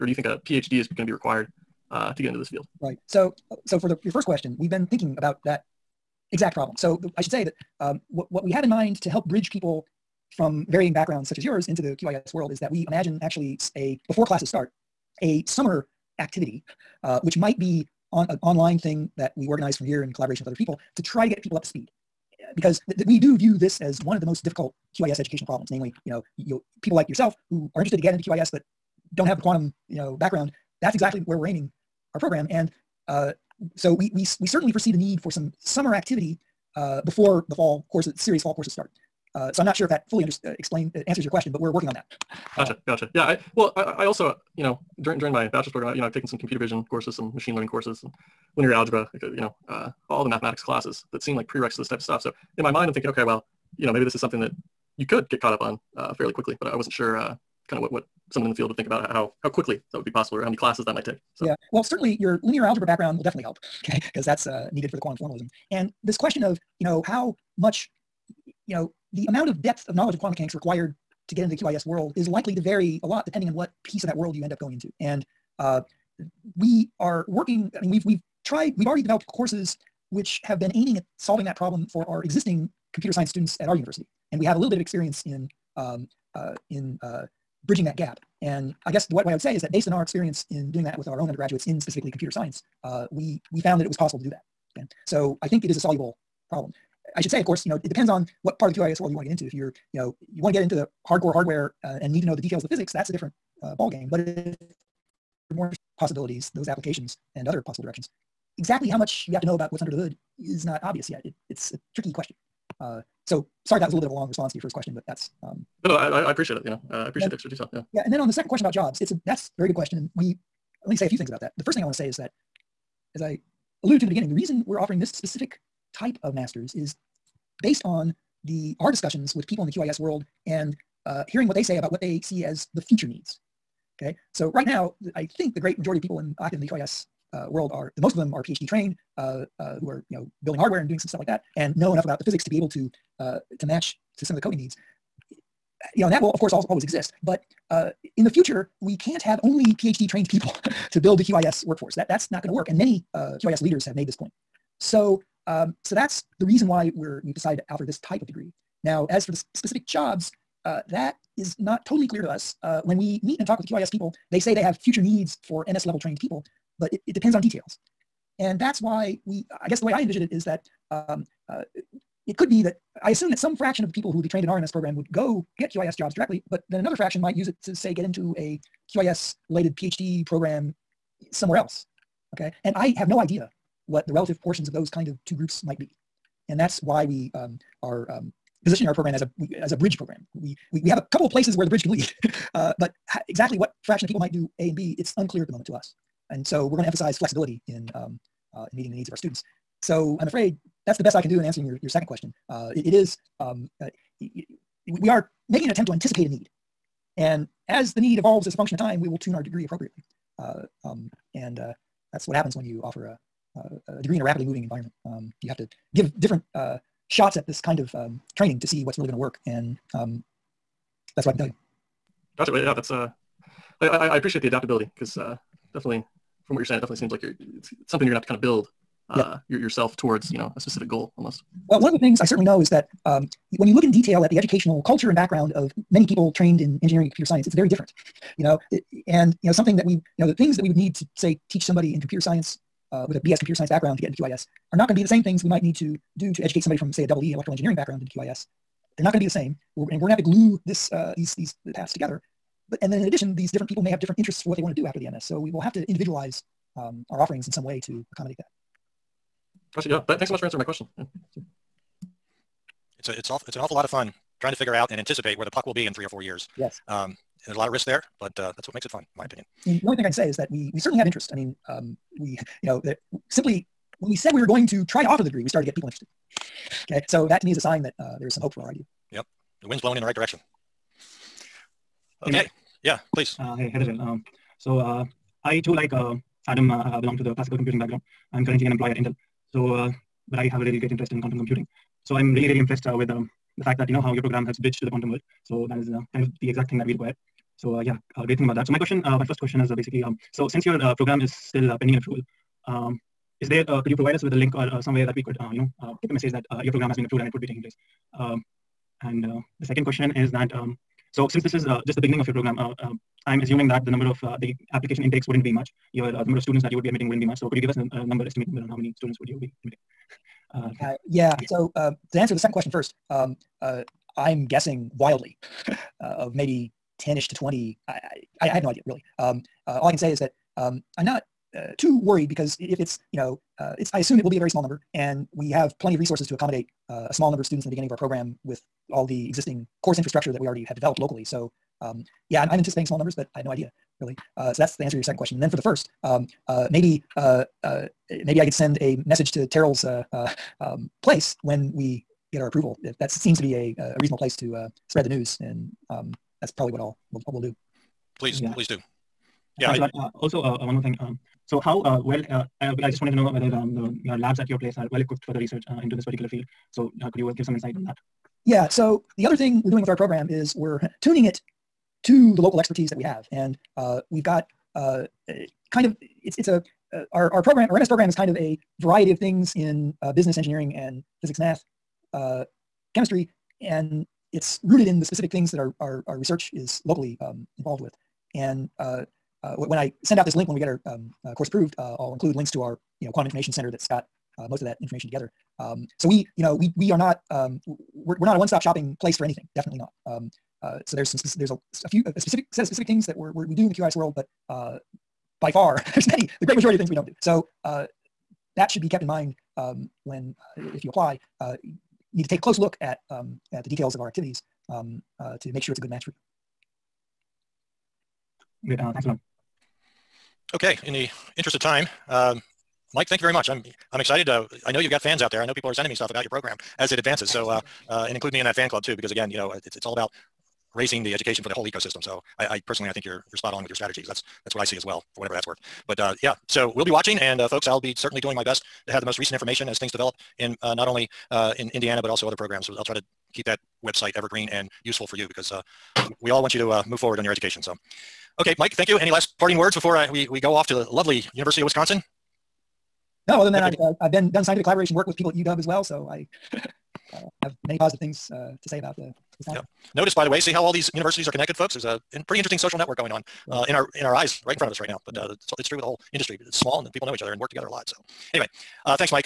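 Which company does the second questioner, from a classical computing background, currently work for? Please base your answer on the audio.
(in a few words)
Intel.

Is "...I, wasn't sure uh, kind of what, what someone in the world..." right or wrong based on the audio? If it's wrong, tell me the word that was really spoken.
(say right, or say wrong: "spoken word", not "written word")
wrong: "field", not "world".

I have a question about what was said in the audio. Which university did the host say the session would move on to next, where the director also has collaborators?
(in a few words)
University of Wisconsin.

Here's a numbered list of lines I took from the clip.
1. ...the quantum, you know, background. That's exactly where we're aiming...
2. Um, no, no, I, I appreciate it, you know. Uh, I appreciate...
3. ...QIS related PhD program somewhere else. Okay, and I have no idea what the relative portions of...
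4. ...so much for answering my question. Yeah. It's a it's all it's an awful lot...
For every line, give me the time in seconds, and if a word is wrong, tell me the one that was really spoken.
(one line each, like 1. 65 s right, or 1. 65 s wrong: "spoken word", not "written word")
1. 29 s right
2. 115 s right
3. 178 s right
4. 260 s right.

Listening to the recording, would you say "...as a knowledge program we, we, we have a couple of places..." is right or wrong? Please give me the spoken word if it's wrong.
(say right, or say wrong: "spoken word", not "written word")
wrong: "bridge", not "knowledge".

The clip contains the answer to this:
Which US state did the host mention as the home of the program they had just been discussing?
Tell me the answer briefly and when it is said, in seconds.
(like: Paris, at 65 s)
Indiana, at 441 s.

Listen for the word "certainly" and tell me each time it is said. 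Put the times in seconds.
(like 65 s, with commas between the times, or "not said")
34 s, 61 s, 232 s, 270 s, 437 s.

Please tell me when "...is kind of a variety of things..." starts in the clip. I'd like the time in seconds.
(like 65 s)
378 s.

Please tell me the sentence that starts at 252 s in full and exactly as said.
But, and then in addition, these different people may have different interests for what they want to do after the MS.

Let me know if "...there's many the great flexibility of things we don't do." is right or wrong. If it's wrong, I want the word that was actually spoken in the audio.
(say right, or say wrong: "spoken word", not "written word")
wrong: "majority", not "flexibility".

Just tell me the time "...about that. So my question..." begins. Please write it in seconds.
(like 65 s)
298 s.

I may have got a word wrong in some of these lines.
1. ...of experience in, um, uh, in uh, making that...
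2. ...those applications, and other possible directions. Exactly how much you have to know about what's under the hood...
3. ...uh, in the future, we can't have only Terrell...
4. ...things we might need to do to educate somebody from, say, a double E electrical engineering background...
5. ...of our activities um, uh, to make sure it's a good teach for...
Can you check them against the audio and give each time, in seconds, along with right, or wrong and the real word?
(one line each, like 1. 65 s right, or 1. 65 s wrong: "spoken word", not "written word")
1. 84 s wrong: "bridging", not "making"
2. 106 s right
3. 147 s wrong: "PhD", not "Terrell"
4. 245 s right
5. 413 s wrong: "match", not "teach".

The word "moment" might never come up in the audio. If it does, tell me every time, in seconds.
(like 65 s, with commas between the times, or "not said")
195 s.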